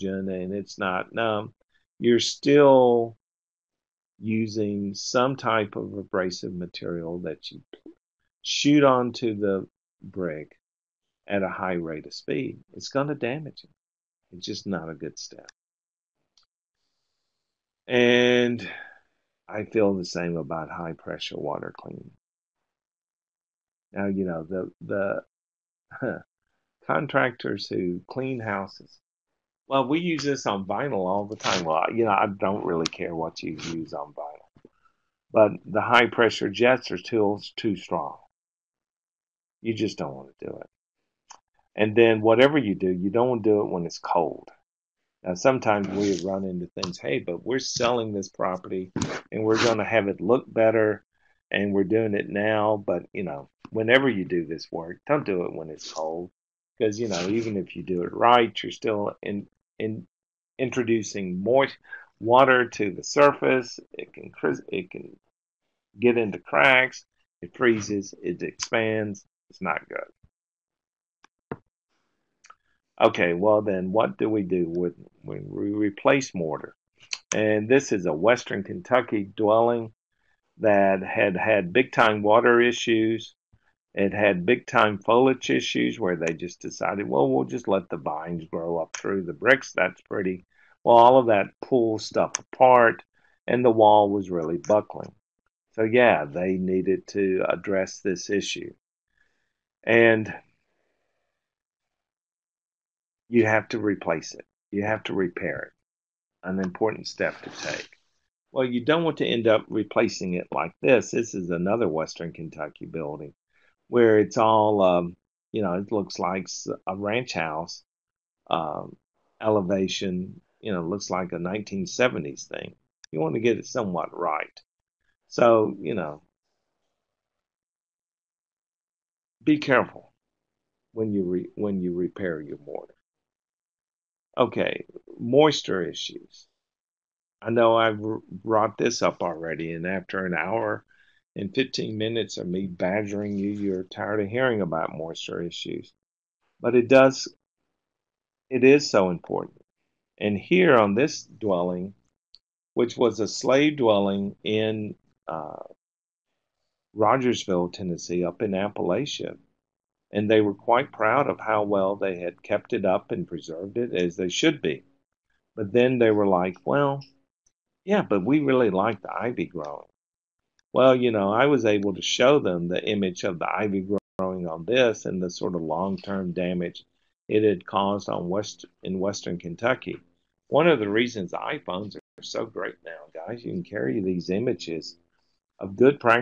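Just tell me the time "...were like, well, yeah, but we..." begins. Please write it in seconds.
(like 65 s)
166 s.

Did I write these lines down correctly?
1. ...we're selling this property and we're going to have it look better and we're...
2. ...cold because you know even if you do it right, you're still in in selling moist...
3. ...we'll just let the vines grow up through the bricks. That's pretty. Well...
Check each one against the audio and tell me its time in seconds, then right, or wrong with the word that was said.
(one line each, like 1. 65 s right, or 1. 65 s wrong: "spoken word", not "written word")
1. 47 s right
2. 55 s wrong: "introducing", not "selling"
3. 87 s right.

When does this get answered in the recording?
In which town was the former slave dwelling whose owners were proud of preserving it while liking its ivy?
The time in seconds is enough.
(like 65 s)
156 s.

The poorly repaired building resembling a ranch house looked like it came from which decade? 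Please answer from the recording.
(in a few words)
1970s.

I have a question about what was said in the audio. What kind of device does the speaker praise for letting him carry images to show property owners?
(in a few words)
iPhones.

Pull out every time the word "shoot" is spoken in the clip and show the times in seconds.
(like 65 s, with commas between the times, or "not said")
8 s.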